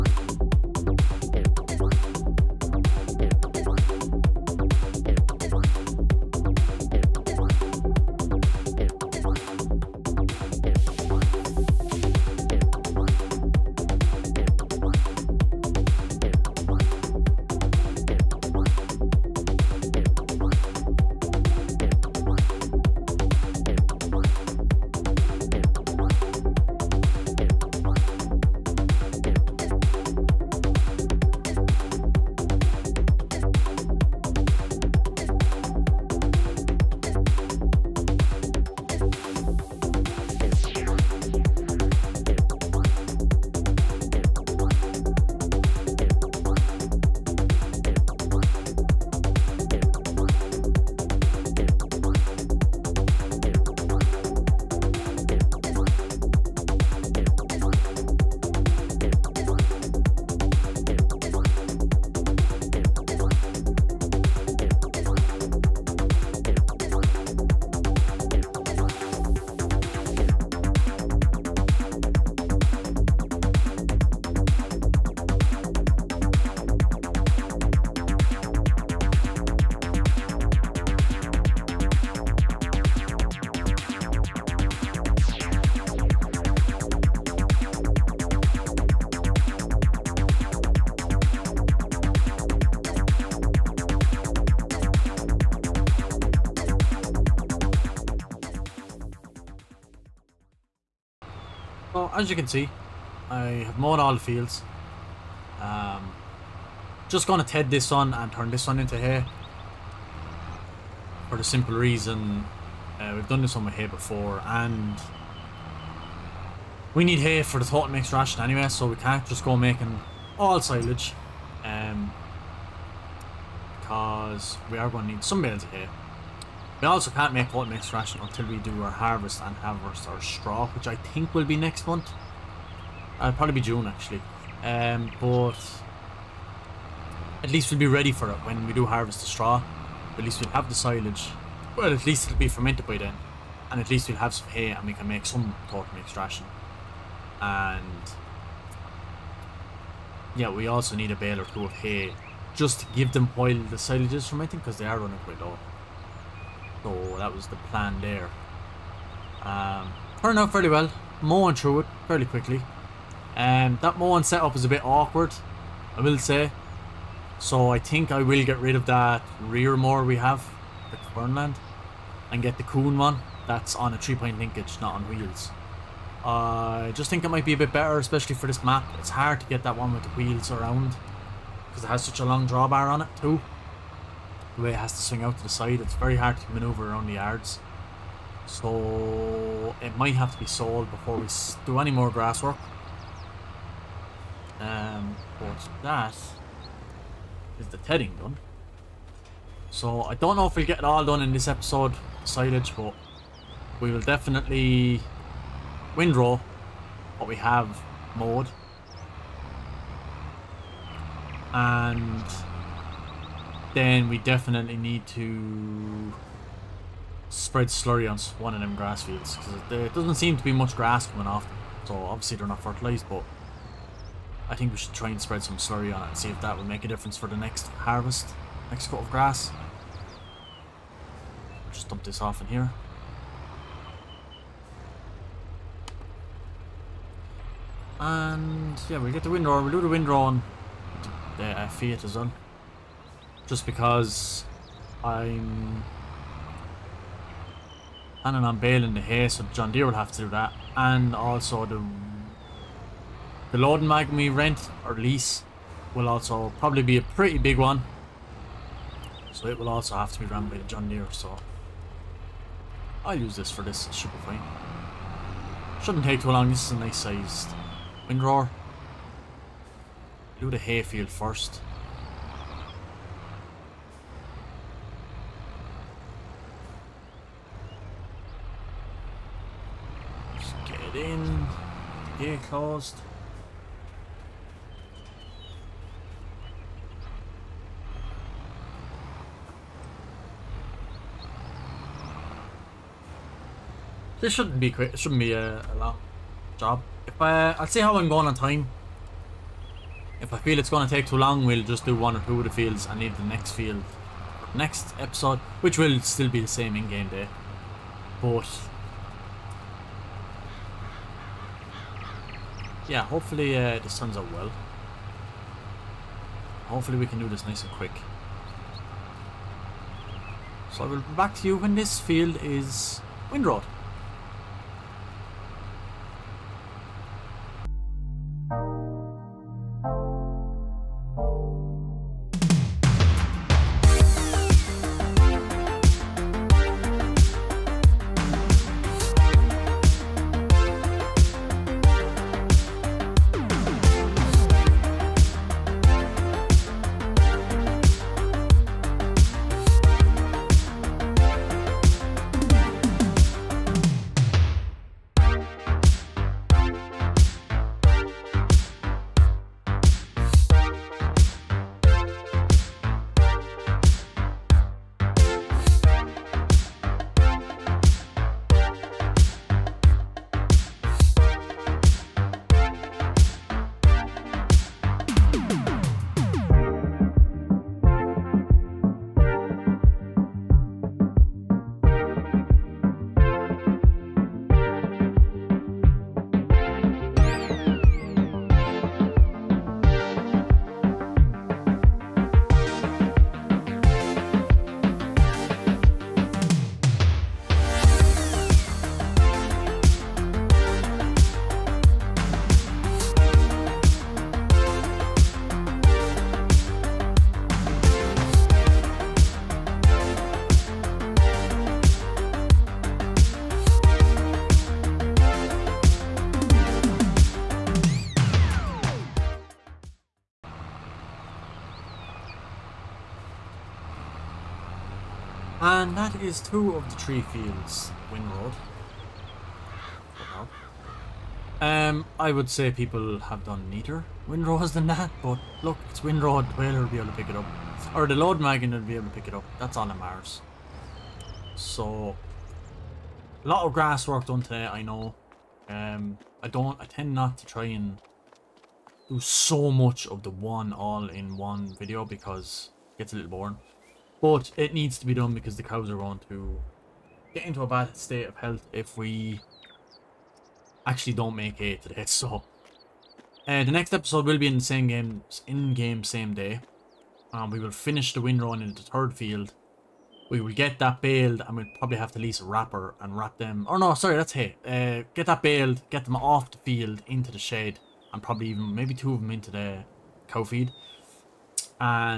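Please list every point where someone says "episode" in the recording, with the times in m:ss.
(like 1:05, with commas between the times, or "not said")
3:21, 5:05, 7:43.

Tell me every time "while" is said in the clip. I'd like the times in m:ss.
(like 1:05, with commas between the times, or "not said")
2:33.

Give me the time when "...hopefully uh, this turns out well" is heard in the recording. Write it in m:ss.
5:13.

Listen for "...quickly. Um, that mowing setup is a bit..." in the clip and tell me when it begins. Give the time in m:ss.
2:42.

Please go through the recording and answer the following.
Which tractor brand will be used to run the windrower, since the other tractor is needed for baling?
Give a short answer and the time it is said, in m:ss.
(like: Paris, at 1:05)
Fiat, at 4:01.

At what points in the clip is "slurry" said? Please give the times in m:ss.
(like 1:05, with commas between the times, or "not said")
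3:37, 3:45.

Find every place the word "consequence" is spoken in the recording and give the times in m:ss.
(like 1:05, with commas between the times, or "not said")
not said.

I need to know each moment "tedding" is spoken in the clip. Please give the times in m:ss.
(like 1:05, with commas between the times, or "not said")
3:17.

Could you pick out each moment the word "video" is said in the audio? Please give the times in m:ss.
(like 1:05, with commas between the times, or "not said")
7:31.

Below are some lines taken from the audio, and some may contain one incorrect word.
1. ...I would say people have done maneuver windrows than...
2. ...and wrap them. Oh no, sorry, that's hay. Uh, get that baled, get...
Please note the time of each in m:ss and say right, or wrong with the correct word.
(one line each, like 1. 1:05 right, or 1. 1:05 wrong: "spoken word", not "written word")
1. 7:12 wrong: "neater", not "maneuver"
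2. 7:53 right.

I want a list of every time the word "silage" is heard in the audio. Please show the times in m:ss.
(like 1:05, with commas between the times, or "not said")
2:00, 2:20, 2:33, 3:22.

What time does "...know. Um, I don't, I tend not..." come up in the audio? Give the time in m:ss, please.
7:24.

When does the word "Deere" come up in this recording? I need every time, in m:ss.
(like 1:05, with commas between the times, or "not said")
4:09, 4:20.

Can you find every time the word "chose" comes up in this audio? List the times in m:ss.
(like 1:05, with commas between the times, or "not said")
not said.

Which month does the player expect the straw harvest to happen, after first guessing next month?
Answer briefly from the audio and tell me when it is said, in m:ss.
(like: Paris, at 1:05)
June, at 2:13.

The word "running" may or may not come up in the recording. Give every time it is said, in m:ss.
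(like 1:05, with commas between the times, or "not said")
2:34.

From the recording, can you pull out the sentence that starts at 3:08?
So it might have to be sold before we do any more grass work.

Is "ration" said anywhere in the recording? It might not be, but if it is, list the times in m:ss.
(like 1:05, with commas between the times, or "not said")
1:58, 2:07, 2:26.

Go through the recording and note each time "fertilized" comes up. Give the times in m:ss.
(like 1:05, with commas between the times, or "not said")
3:42.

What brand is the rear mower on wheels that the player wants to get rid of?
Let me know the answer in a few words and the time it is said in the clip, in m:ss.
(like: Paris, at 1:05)
Kverneland, at 2:50.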